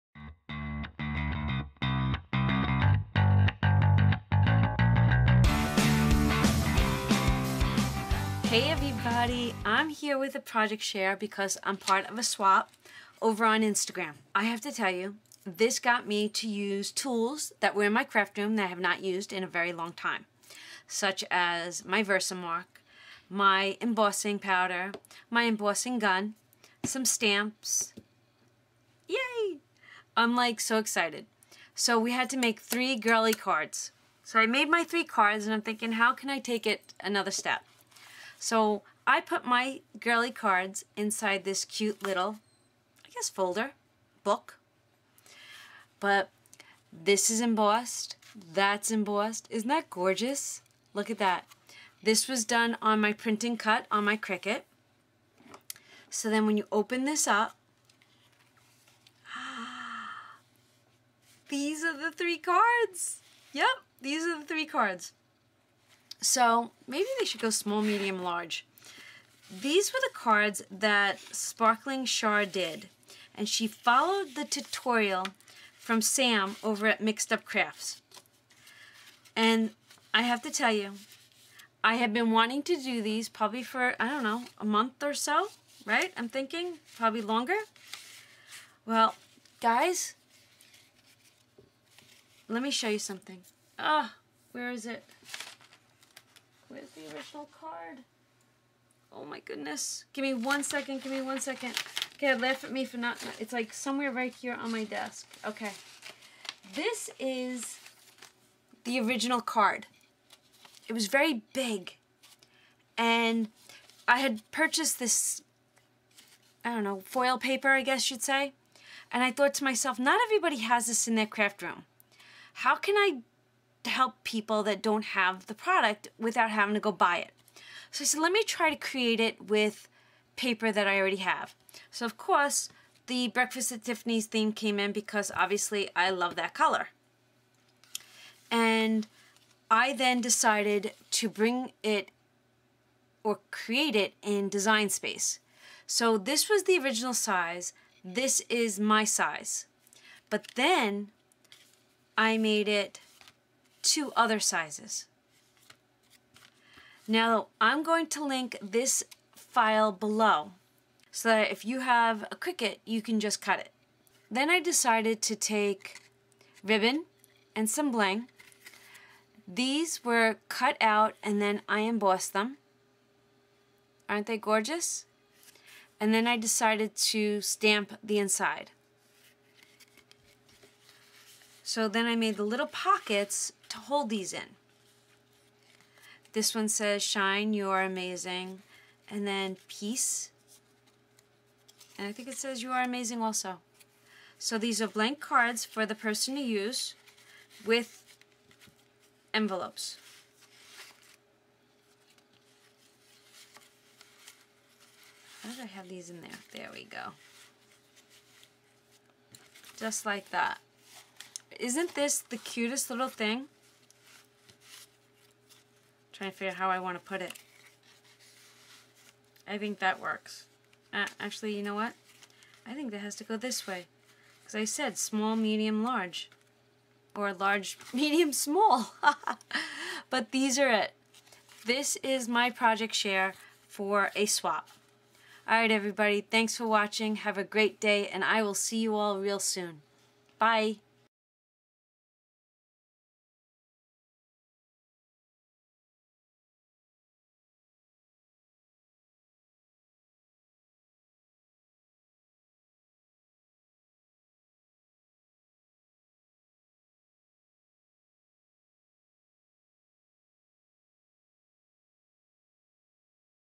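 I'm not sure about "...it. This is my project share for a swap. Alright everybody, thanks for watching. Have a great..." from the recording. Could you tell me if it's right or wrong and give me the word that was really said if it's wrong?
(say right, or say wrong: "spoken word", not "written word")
right.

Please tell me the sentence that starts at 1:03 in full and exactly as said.
Yep, these are the three cards.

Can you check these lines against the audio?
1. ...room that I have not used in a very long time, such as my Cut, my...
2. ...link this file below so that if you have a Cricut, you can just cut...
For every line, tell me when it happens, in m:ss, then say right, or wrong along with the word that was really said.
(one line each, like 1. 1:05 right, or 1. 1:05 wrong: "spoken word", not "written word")
1. 0:18 wrong: "Versamark", not "Cut"
2. 2:38 right.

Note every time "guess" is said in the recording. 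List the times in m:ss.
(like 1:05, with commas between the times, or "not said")
0:43, 1:57.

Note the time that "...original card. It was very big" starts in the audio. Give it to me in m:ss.
1:49.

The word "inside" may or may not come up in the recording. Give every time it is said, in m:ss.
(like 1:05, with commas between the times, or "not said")
0:40, 2:58.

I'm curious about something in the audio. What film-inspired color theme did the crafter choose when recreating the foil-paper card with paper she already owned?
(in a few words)
Breakfast at Tiffany's.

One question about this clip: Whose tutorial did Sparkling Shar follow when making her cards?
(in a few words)
Sam.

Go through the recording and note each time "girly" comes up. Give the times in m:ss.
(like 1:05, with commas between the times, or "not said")
0:32, 0:39.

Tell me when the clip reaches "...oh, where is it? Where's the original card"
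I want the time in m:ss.
1:34.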